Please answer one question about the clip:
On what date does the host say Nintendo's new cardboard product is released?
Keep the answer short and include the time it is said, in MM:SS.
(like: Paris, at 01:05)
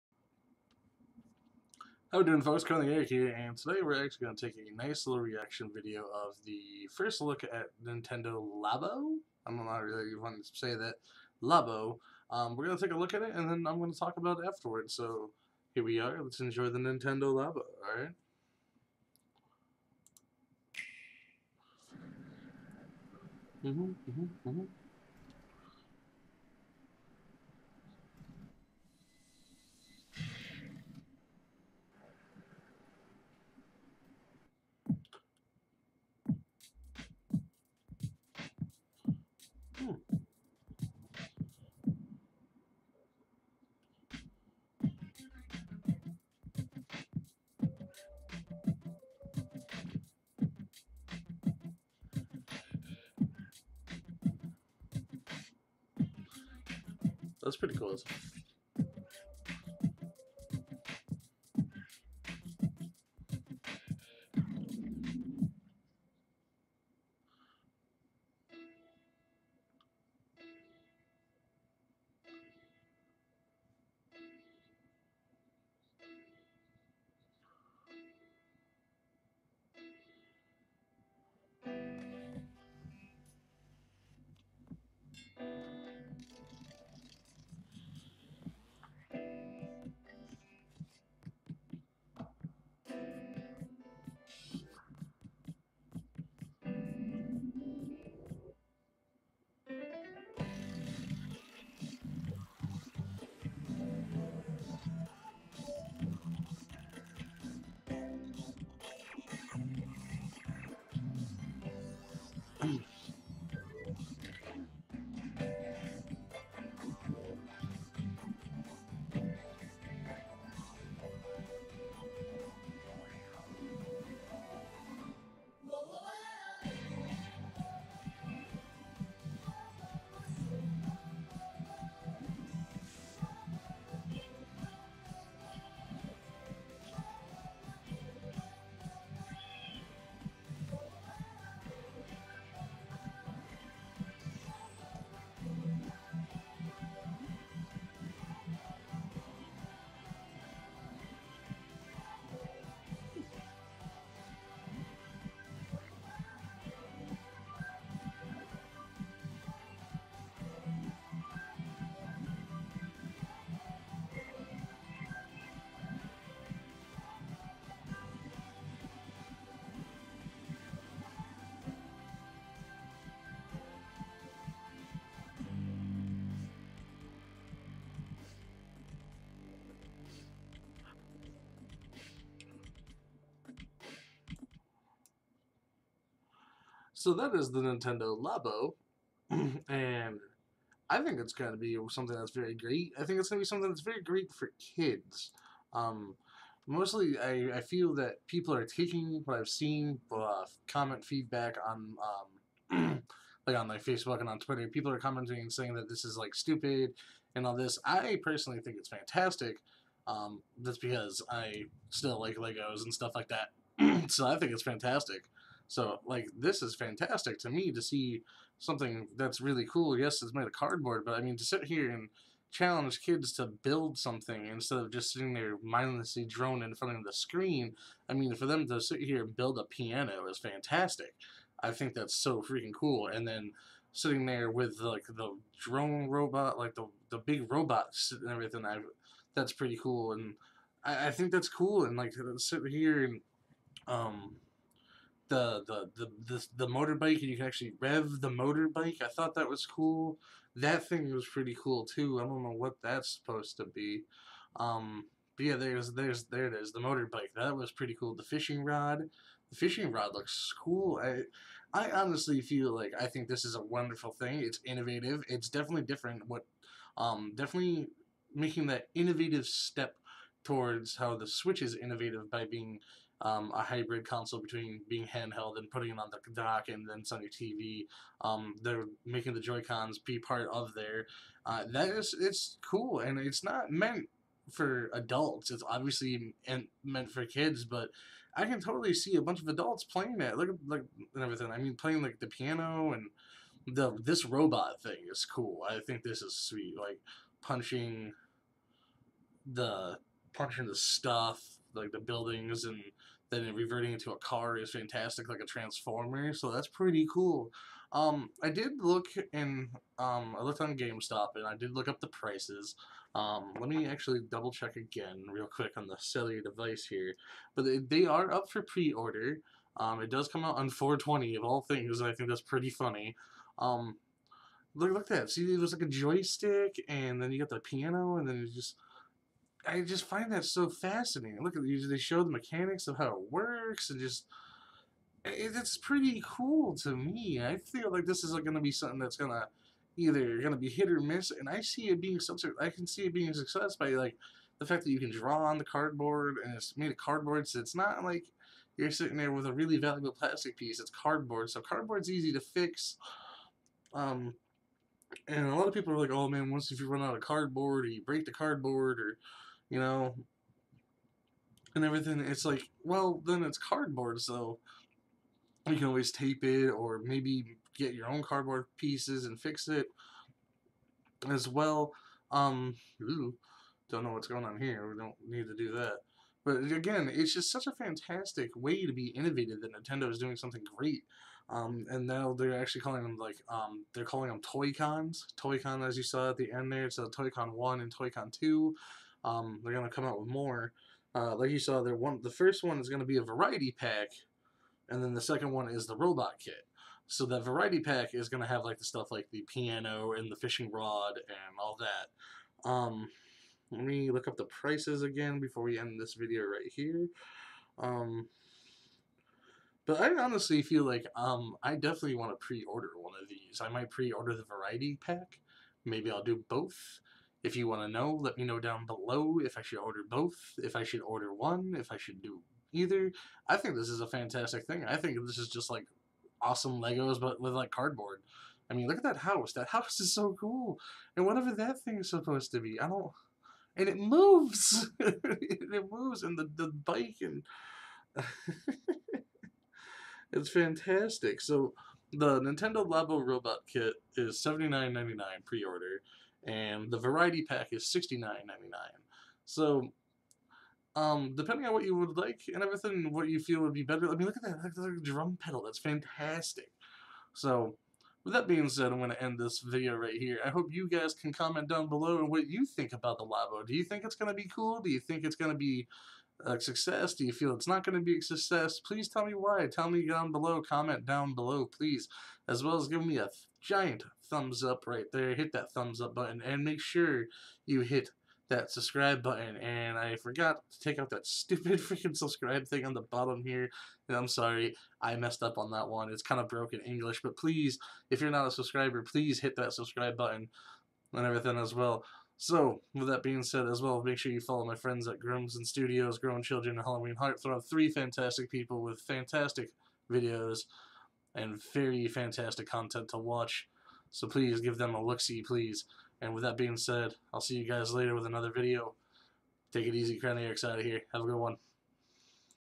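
4/20, at 05:20.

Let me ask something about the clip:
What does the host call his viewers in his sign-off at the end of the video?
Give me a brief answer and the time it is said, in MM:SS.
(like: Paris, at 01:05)
Craniacs, at 08:30.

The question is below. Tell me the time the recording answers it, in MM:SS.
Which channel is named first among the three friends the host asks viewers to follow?
08:15.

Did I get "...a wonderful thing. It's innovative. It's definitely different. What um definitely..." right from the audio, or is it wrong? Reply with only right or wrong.
right.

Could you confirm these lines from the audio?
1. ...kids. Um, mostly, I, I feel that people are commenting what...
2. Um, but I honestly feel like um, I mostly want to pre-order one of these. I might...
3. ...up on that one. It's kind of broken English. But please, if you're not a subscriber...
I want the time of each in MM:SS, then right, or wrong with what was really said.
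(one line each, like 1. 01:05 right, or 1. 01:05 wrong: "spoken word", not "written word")
1. 03:14 wrong: "taking", not "commenting"
2. 06:47 wrong: "definitely", not "mostly"
3. 08:05 right.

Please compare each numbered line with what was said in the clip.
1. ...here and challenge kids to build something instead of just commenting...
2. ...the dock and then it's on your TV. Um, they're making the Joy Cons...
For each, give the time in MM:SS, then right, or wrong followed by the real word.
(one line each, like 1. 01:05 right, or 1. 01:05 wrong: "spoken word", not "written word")
1. 03:41 wrong: "sitting", not "commenting"
2. 04:36 right.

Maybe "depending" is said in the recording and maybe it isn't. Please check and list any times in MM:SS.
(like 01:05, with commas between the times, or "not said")
07:31.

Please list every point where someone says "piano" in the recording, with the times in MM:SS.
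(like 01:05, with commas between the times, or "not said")
03:49, 04:52, 05:27, 06:39.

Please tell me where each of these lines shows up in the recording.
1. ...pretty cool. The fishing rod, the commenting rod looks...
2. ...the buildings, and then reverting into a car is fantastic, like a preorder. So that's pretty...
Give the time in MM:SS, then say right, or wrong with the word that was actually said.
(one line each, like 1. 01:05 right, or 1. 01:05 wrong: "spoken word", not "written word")
1. 04:17 wrong: "fishing", not "commenting"
2. 05:01 wrong: "transformer", not "preorder".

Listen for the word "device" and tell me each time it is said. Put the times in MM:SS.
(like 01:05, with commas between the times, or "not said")
05:16.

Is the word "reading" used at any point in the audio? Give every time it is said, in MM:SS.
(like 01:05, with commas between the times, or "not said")
not said.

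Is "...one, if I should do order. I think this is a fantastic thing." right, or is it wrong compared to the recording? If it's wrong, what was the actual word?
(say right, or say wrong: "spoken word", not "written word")
wrong: "either", not "order".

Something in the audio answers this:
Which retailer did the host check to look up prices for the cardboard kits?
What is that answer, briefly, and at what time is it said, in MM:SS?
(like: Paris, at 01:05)
GameStop, at 05:10.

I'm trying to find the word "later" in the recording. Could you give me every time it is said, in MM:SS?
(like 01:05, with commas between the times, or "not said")
08:27.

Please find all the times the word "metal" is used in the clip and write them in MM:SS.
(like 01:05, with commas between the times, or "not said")
not said.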